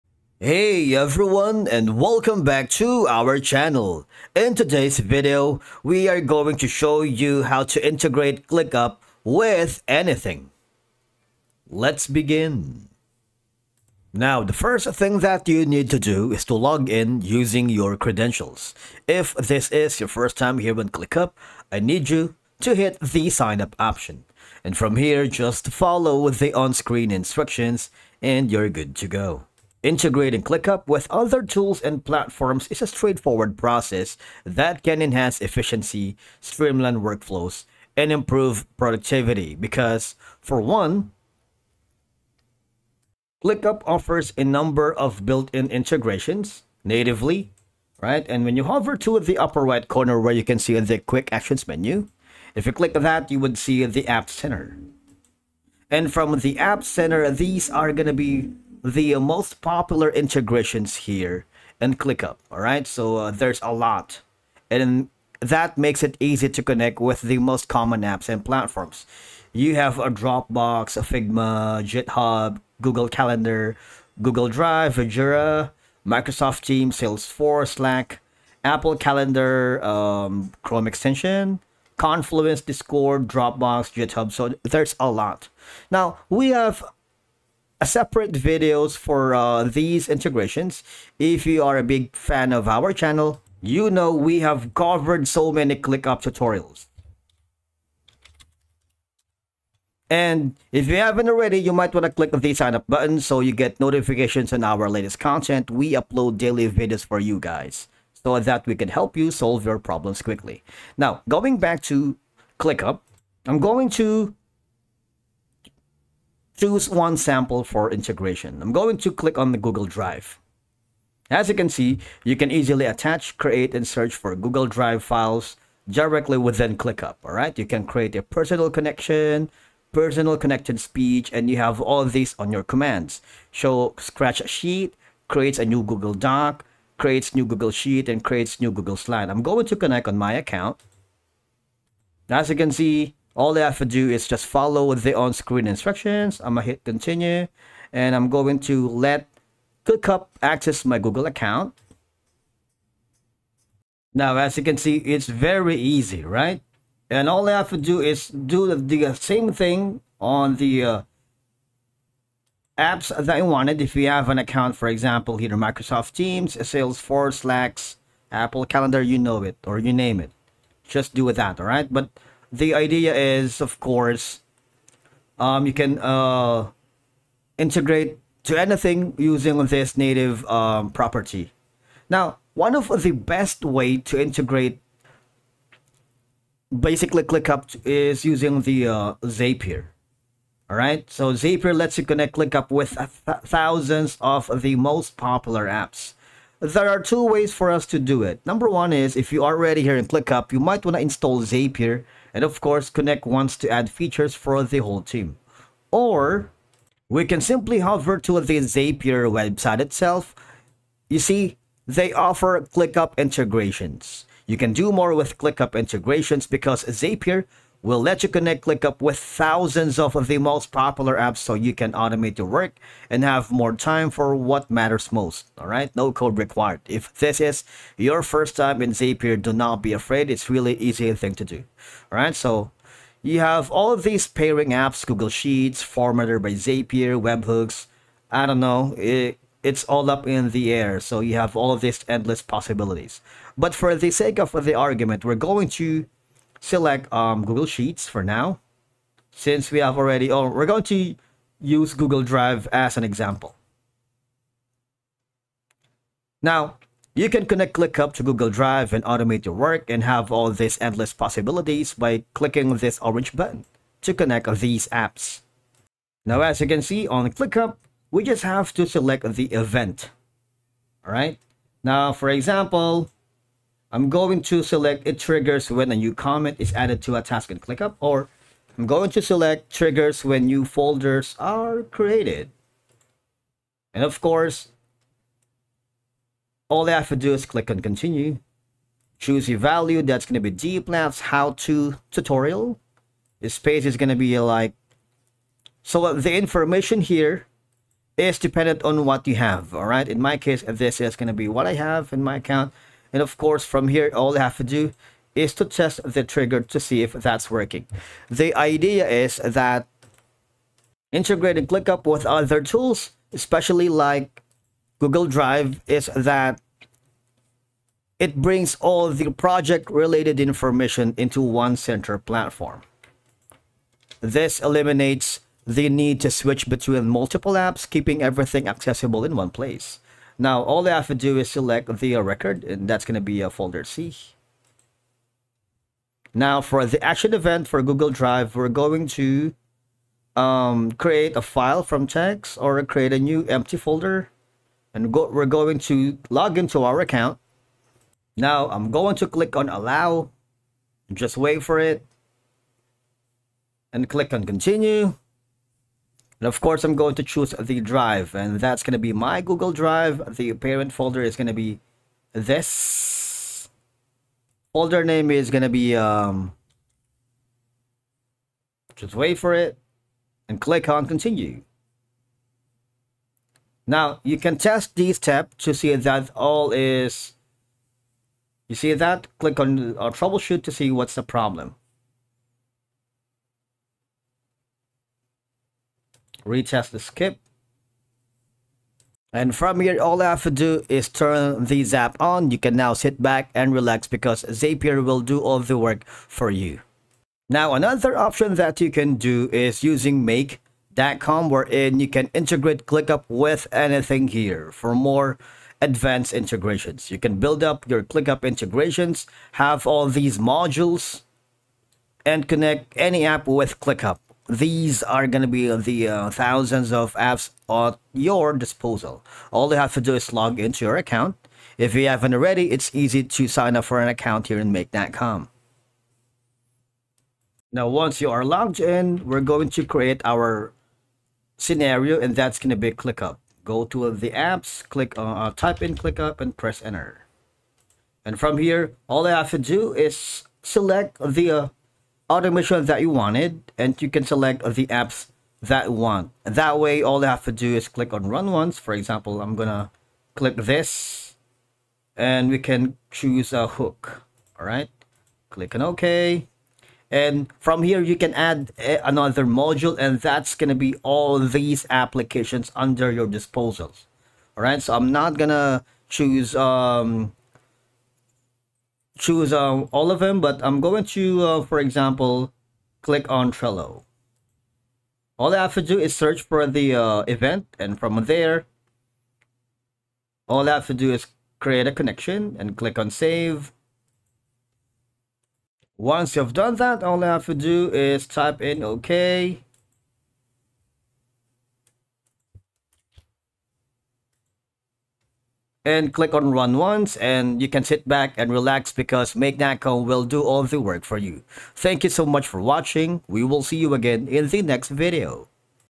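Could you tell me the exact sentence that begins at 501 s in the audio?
Thank you so much for watching.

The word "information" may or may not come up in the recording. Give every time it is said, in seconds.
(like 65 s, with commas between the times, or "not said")
296 s, 320 s.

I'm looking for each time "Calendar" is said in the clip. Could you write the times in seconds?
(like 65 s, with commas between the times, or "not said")
73 s, 78 s, 168 s.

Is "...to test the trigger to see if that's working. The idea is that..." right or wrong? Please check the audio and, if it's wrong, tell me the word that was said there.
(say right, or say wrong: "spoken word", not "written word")
right.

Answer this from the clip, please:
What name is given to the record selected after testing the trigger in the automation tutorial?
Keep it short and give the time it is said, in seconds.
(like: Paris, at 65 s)
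Folder C, at 333 s.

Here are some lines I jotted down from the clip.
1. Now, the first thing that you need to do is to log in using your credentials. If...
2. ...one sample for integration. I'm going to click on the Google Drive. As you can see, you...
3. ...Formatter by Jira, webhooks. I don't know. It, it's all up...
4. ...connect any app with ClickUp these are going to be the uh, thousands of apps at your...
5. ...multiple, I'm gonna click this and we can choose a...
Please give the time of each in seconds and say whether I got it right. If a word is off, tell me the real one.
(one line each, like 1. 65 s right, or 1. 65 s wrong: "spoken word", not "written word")
1. 14 s right
2. 116 s right
3. 235 s wrong: "Zapier", not "Jira"
4. 412 s right
5. 448 s wrong: "example", not "multiple".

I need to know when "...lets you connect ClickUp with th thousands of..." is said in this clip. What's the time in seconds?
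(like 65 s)
191 s.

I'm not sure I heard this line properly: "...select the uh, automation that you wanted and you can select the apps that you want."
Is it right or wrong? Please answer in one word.
right.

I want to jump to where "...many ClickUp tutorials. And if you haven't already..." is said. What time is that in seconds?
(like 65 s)
95 s.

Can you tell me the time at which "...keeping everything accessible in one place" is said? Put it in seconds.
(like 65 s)
327 s.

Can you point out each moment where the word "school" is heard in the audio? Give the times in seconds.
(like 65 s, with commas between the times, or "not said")
not said.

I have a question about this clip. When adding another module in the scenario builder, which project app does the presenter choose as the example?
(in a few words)
Trello.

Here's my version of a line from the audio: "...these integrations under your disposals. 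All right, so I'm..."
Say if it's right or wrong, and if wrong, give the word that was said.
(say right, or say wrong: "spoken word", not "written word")
wrong: "applications", not "integrations".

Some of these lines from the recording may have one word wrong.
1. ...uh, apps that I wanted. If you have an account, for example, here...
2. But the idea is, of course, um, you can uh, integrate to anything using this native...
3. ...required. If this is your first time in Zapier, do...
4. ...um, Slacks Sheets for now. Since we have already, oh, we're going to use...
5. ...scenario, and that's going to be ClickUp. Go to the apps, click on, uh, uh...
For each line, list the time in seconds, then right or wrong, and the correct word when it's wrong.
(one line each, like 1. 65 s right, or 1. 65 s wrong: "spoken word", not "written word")
1. 160 s right
2. 171 s right
3. 226 s right
4. 247 s wrong: "Google", not "Slacks"
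5. 431 s right.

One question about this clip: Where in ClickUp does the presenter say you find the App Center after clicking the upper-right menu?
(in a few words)
Quick actions menu.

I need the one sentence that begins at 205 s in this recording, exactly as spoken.
Or we can simply hover to the Zapier website itself.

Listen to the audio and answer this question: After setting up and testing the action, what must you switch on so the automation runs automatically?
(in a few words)
The zap.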